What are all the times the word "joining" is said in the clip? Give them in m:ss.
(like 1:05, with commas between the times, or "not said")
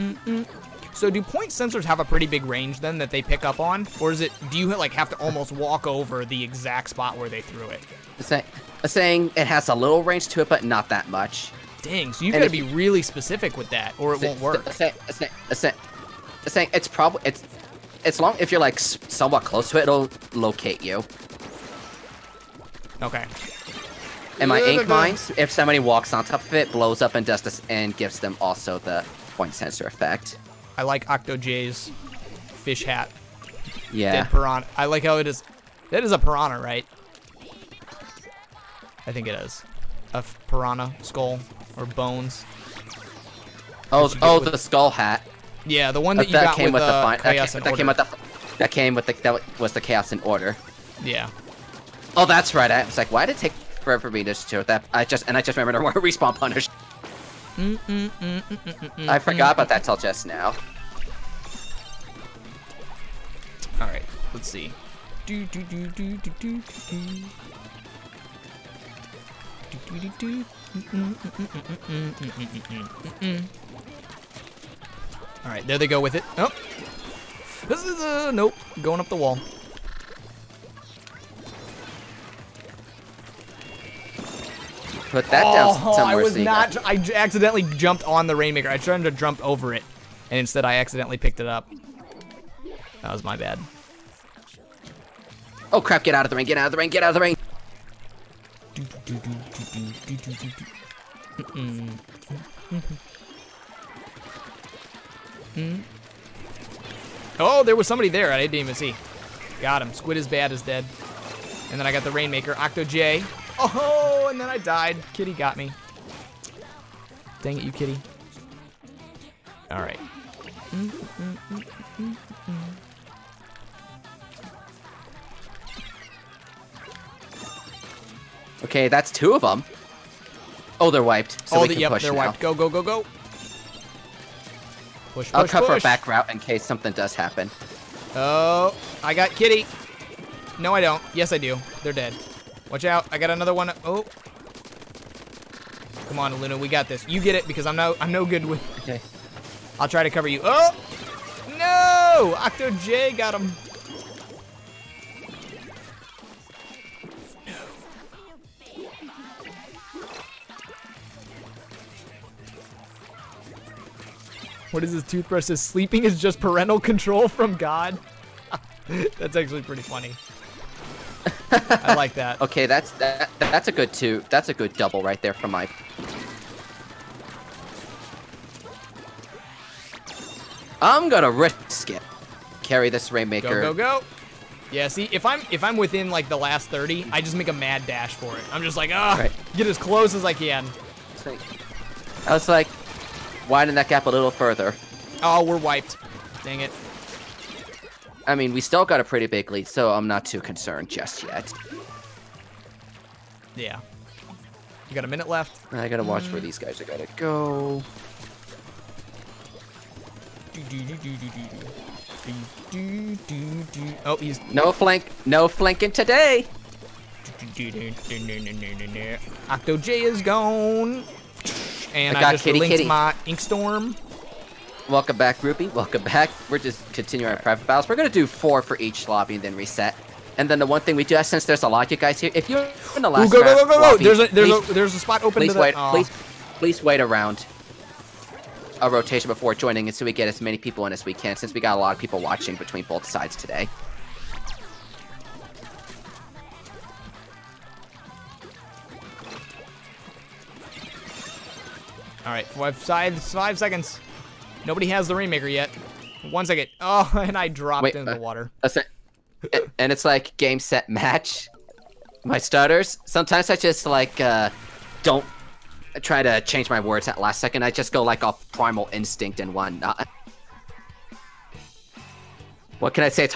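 3:59.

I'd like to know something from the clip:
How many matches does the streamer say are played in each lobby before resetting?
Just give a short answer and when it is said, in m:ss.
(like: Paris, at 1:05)
4, at 3:48.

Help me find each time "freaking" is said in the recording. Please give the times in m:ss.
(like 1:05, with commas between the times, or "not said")
not said.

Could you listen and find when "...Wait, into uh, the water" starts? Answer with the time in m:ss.
4:17.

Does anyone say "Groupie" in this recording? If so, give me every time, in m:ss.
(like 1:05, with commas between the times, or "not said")
3:45.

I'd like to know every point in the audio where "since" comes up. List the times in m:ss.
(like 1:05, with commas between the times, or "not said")
3:51, 4:01.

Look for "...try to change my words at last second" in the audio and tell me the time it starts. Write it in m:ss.
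4:26.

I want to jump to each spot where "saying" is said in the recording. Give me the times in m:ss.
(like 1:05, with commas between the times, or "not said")
0:08, 0:16.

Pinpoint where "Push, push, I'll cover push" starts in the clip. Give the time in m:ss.
2:15.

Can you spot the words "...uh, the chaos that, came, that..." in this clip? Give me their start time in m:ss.
0:46.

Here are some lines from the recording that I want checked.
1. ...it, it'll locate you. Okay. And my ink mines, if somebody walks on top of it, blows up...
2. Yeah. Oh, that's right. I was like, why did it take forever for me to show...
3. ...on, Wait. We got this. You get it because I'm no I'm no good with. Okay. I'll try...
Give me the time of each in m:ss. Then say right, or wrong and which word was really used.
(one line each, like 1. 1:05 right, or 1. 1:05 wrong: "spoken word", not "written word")
1. 0:19 right
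2. 0:51 right
3. 2:26 wrong: "Luna", not "Wait".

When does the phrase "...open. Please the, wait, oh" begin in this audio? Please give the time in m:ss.
3:55.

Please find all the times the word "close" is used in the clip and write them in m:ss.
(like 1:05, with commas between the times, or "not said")
0:19, 3:09.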